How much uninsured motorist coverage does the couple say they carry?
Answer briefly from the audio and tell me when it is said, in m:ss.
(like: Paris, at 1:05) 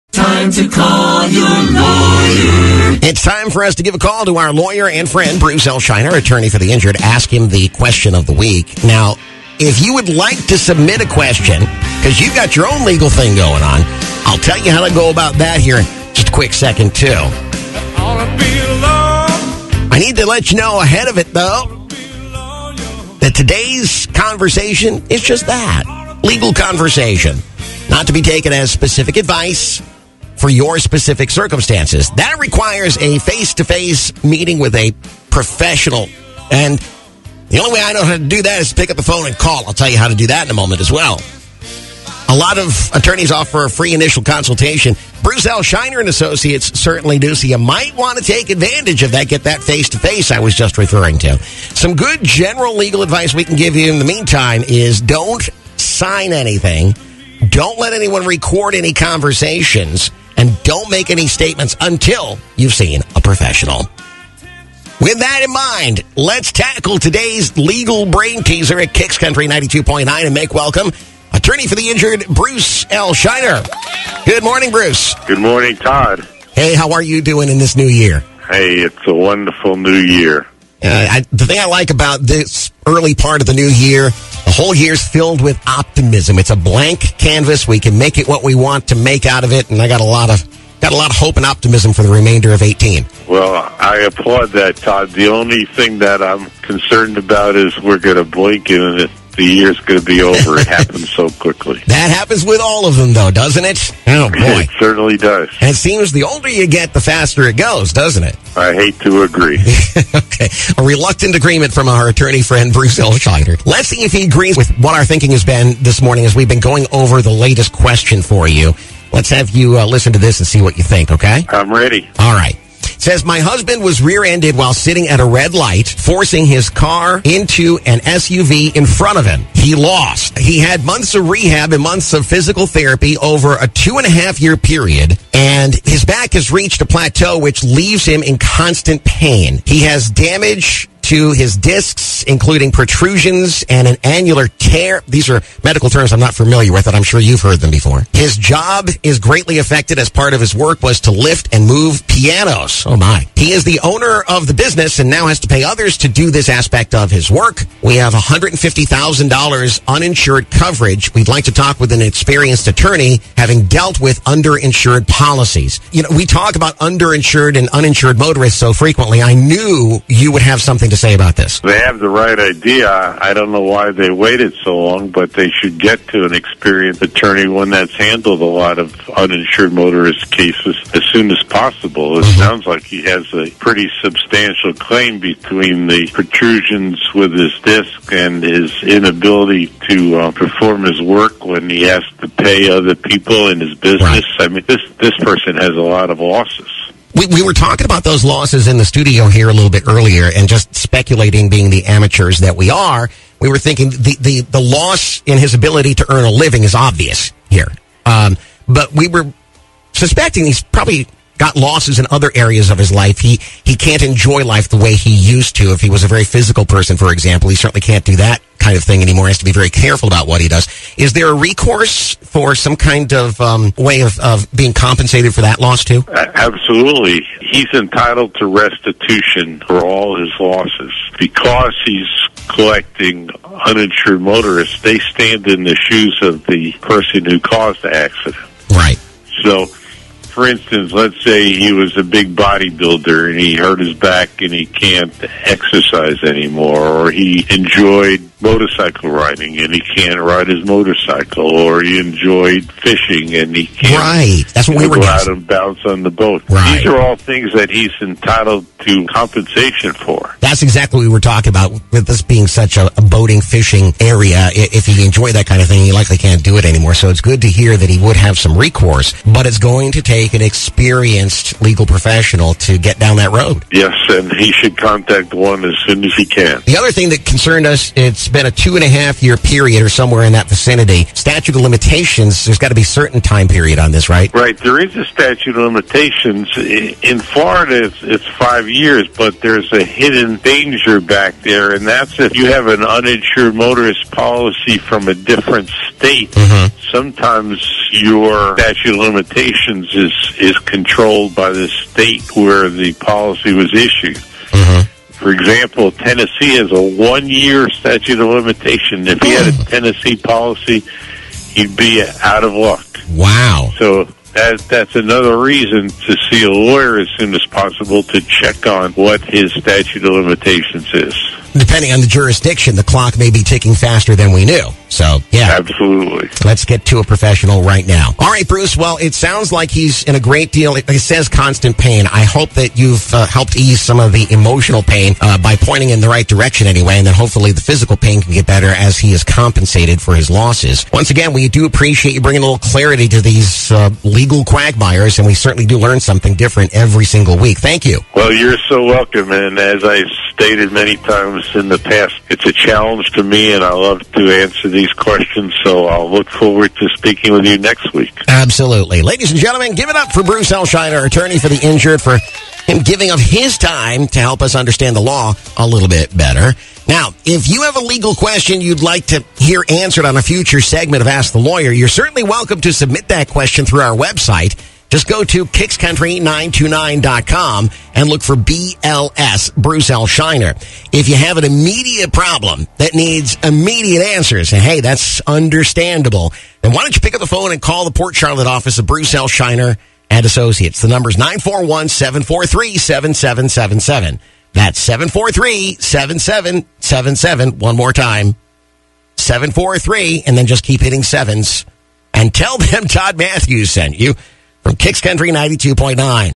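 $150,000, at 2:38.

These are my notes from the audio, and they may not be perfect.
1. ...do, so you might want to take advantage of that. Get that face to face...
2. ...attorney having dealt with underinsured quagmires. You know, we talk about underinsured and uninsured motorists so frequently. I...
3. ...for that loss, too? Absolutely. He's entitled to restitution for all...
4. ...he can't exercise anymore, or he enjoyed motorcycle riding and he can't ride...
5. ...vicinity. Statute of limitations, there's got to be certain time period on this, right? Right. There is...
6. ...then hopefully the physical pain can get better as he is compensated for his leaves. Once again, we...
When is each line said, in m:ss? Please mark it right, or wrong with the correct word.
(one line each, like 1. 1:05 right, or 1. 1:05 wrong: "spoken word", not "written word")
1. 0:47 right
2. 2:42 wrong: "policies", not "quagmires"
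3. 3:45 right
4. 4:04 right
5. 4:40 right
6. 5:37 wrong: "losses", not "leaves".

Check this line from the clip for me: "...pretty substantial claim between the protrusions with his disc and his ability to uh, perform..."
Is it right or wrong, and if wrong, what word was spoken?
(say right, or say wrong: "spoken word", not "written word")
wrong: "inability", not "ability".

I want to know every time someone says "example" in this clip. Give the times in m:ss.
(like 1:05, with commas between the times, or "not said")
3:37, 5:05.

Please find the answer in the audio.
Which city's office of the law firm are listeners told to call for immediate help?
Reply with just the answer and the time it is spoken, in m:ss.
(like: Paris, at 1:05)
Port Charlotte, at 6:27.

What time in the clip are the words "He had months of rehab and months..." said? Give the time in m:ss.
2:10.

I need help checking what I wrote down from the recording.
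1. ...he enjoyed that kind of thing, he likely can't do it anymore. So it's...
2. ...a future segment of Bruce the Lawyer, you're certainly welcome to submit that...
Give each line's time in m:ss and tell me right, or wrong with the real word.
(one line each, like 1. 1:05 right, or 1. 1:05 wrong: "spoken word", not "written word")
1. 4:24 right
2. 6:10 wrong: "Ask", not "Bruce".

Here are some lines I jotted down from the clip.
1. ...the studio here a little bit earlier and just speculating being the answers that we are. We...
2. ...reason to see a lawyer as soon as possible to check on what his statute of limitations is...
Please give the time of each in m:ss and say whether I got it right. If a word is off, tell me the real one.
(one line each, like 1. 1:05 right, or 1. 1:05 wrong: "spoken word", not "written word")
1. 3:18 wrong: "amateurs", not "answers"
2. 5:15 right.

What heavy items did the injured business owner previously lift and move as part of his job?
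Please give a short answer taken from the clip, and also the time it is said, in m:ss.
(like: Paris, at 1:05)
pianos, at 2:32.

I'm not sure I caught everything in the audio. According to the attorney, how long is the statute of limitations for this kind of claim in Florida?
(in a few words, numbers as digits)
5 years.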